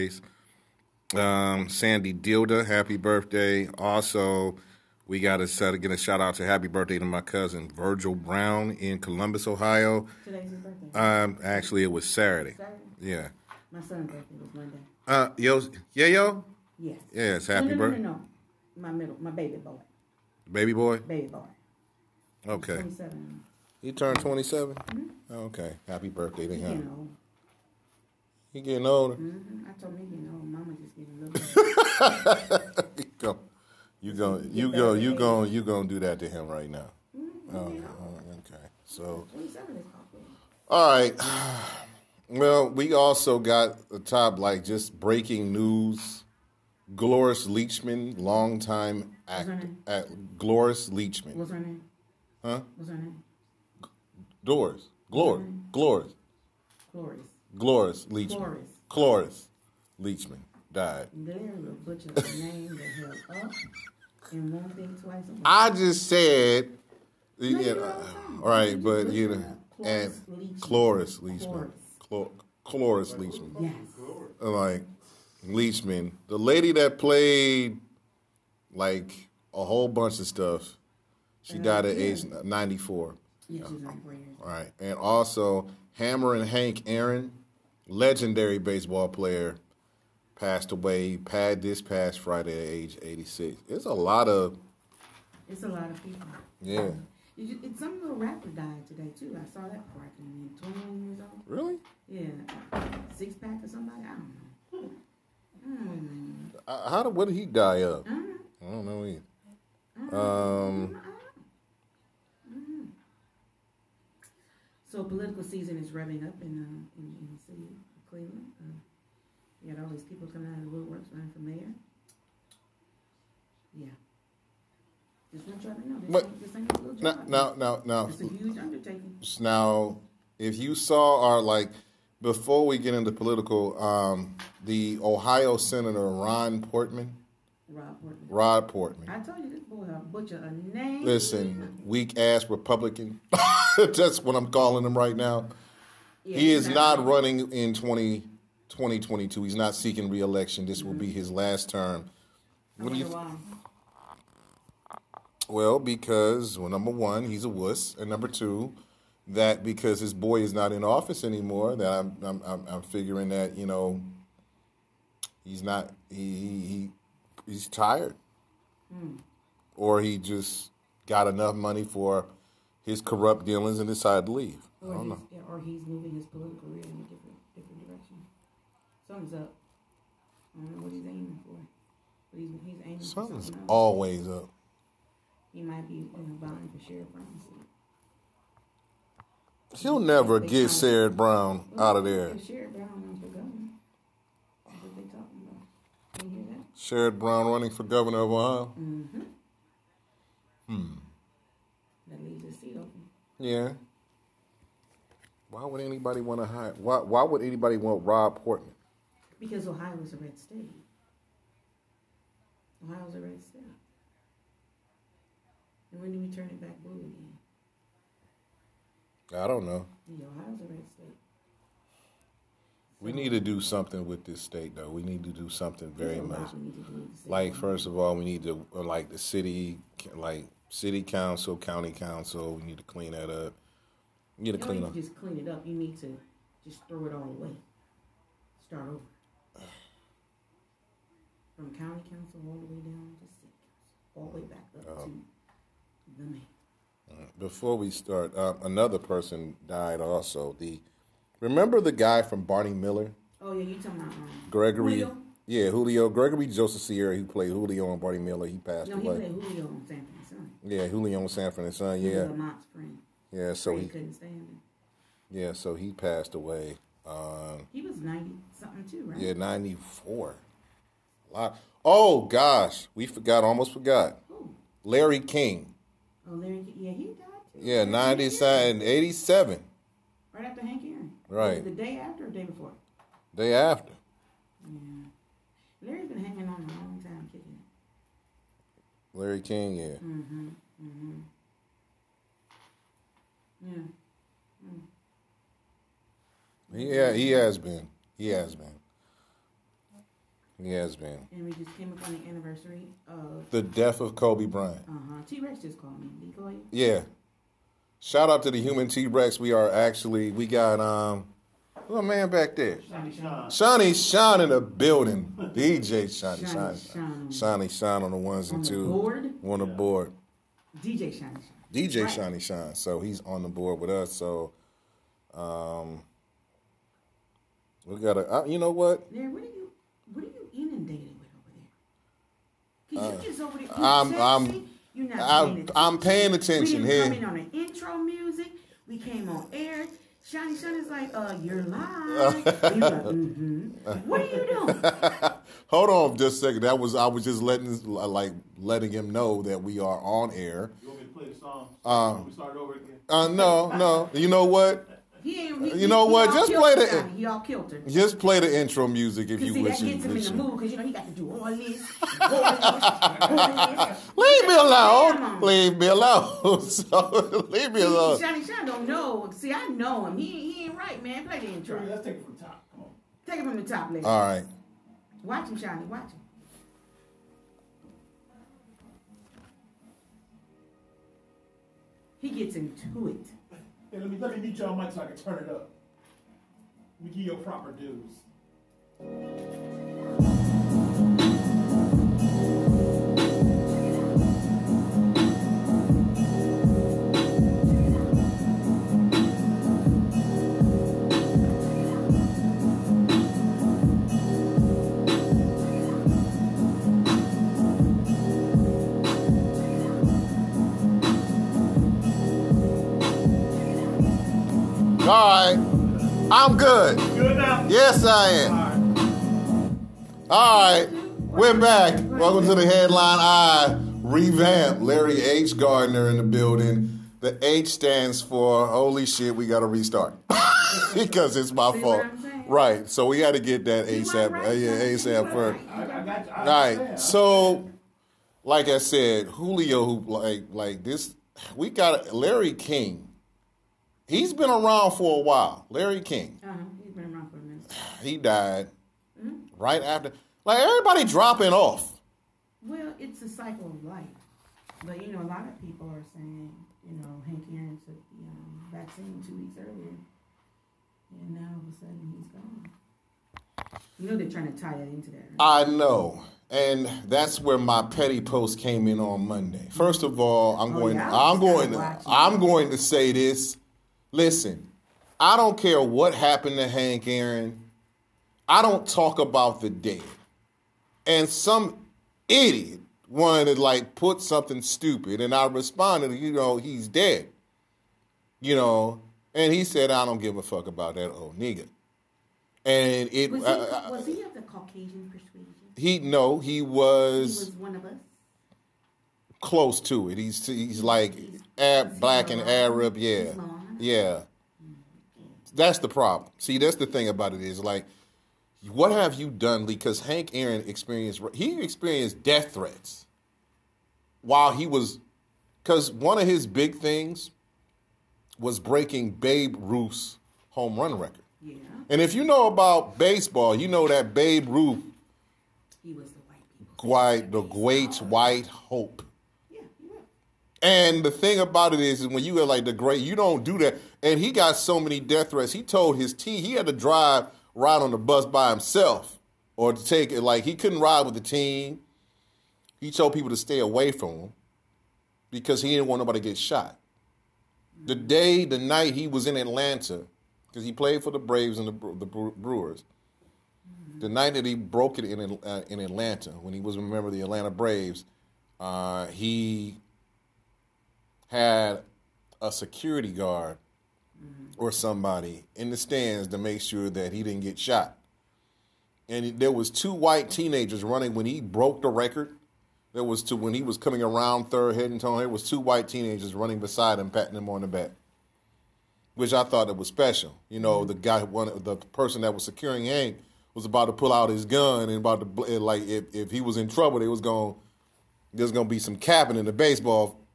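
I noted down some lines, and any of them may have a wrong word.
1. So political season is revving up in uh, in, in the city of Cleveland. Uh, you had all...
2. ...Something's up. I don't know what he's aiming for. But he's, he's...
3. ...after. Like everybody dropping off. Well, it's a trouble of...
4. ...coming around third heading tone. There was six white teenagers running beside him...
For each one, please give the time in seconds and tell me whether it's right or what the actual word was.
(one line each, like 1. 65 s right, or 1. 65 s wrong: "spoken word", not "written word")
1. 114 s right
2. 179 s right
3. 449 s wrong: "cycle", not "trouble"
4. 573 s wrong: "two", not "six".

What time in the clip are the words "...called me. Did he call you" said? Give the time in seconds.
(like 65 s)
305 s.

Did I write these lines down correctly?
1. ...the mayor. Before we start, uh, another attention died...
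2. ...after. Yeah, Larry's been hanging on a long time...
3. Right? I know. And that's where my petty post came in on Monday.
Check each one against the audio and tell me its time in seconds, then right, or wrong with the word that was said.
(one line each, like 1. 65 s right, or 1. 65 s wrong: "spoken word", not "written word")
1. 246 s wrong: "person", not "attention"
2. 283 s right
3. 465 s right.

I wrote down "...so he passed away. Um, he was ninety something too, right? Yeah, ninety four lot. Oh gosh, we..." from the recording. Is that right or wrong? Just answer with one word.
right.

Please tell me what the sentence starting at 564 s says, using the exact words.
or somebody in the stands to make sure that he didn't get shot.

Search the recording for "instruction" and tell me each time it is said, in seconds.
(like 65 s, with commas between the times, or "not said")
not said.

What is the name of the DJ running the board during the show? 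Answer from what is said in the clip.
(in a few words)
DJ Shiny Sean.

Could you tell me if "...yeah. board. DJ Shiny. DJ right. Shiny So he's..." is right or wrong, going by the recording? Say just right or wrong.
right.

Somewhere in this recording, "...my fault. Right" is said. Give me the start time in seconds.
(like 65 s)
431 s.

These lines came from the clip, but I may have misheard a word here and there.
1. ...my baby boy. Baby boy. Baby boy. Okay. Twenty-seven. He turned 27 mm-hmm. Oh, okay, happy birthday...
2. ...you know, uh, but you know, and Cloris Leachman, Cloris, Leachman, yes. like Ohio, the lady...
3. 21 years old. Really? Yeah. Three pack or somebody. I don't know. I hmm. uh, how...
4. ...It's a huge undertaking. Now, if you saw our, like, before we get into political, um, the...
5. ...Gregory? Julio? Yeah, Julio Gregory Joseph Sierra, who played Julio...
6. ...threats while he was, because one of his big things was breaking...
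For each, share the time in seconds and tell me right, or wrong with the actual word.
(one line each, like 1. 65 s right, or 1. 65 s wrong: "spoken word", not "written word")
1. 19 s right
2. 67 s wrong: "Leachman", not "Ohio"
3. 100 s wrong: "Six", not "Three"
4. 128 s right
5. 254 s right
6. 512 s right.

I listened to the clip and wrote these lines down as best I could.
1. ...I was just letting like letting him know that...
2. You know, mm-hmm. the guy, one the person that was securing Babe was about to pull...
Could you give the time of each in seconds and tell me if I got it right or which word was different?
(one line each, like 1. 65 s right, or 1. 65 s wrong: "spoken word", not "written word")
1. 346 s right
2. 580 s wrong: "Hank", not "Babe".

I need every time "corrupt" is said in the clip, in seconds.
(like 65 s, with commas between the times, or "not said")
173 s.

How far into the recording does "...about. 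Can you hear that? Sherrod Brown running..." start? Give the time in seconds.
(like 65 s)
195 s.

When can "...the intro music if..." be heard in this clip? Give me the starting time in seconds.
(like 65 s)
358 s.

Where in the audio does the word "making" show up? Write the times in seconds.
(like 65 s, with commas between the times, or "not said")
not said.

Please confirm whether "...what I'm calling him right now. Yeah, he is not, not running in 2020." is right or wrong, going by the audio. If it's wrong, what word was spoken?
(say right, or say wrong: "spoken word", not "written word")
right.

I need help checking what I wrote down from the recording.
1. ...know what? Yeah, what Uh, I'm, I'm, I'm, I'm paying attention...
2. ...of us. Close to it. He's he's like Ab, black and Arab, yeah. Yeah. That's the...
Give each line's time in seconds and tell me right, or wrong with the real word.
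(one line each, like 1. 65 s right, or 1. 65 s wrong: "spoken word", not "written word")
1. 328 s right
2. 497 s right.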